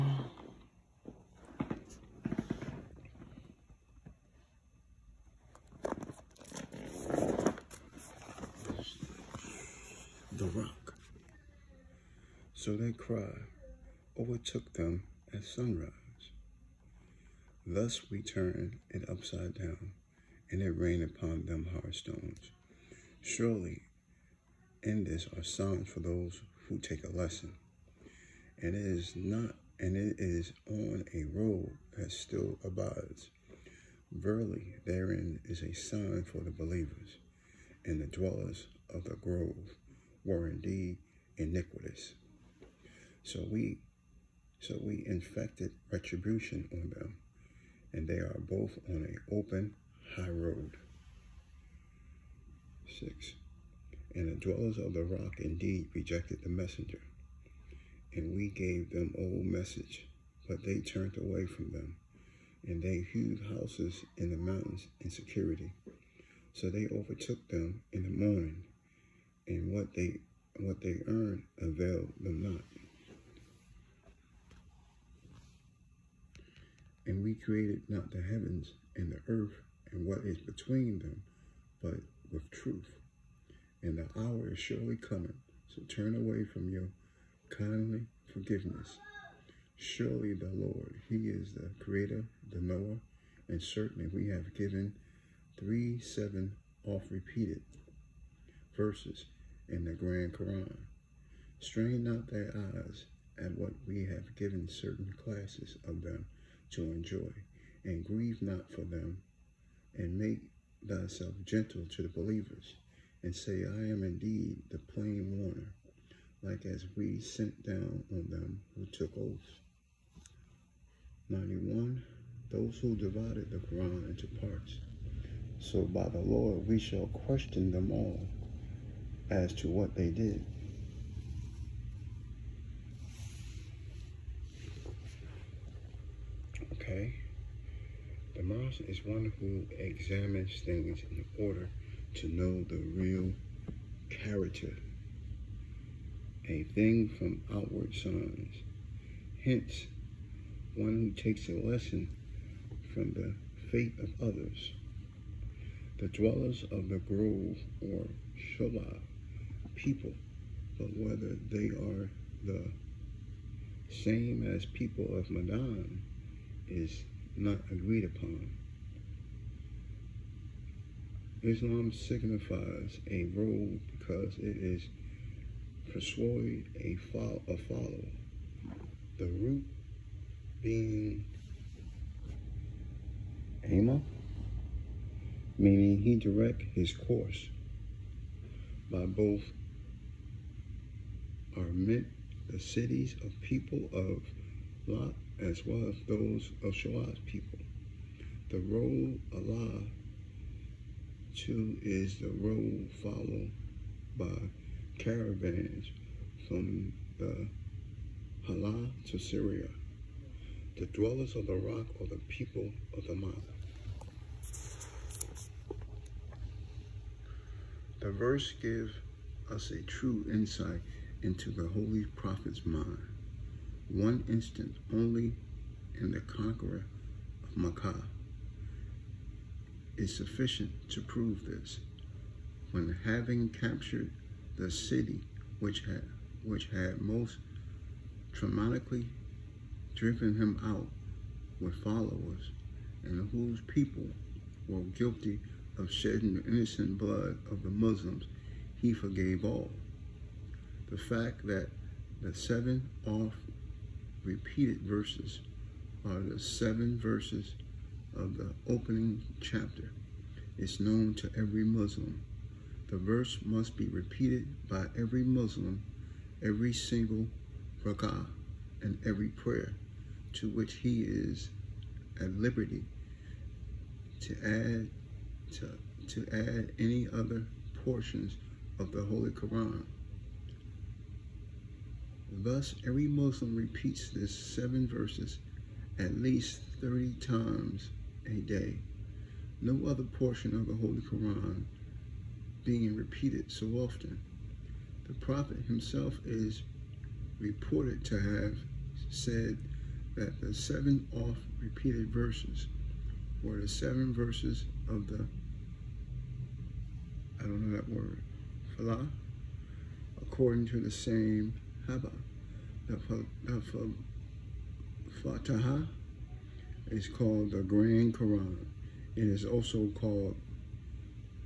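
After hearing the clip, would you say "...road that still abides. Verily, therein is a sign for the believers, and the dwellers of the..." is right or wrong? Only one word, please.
right.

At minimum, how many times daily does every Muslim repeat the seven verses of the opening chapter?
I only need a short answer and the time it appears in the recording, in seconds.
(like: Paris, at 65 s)
30, at 286 s.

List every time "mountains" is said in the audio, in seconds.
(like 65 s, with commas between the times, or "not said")
64 s, 213 s.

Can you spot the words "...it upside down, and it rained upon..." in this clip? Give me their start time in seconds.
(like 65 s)
18 s.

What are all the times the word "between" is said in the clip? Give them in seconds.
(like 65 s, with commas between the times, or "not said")
80 s.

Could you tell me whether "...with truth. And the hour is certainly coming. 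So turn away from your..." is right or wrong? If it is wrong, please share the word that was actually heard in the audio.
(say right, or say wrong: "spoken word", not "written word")
wrong: "surely", not "certainly".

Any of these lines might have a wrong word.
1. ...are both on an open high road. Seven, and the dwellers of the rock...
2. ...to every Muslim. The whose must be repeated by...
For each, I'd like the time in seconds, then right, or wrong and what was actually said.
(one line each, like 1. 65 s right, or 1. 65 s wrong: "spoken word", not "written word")
1. 48 s wrong: "Six", not "Seven"
2. 261 s wrong: "verse", not "whose".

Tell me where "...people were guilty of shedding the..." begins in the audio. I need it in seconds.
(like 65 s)
243 s.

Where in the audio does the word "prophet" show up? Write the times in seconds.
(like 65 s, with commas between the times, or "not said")
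222 s, 295 s.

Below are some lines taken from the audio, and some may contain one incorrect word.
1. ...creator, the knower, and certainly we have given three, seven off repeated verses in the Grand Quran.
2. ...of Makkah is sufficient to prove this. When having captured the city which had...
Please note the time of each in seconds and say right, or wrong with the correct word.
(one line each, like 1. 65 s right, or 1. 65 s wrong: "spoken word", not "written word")
1. 91 s right
2. 227 s right.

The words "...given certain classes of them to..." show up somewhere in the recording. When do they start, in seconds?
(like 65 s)
104 s.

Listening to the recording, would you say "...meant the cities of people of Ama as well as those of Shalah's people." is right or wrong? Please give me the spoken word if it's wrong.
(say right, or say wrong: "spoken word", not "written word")
wrong: "Lot", not "Ama".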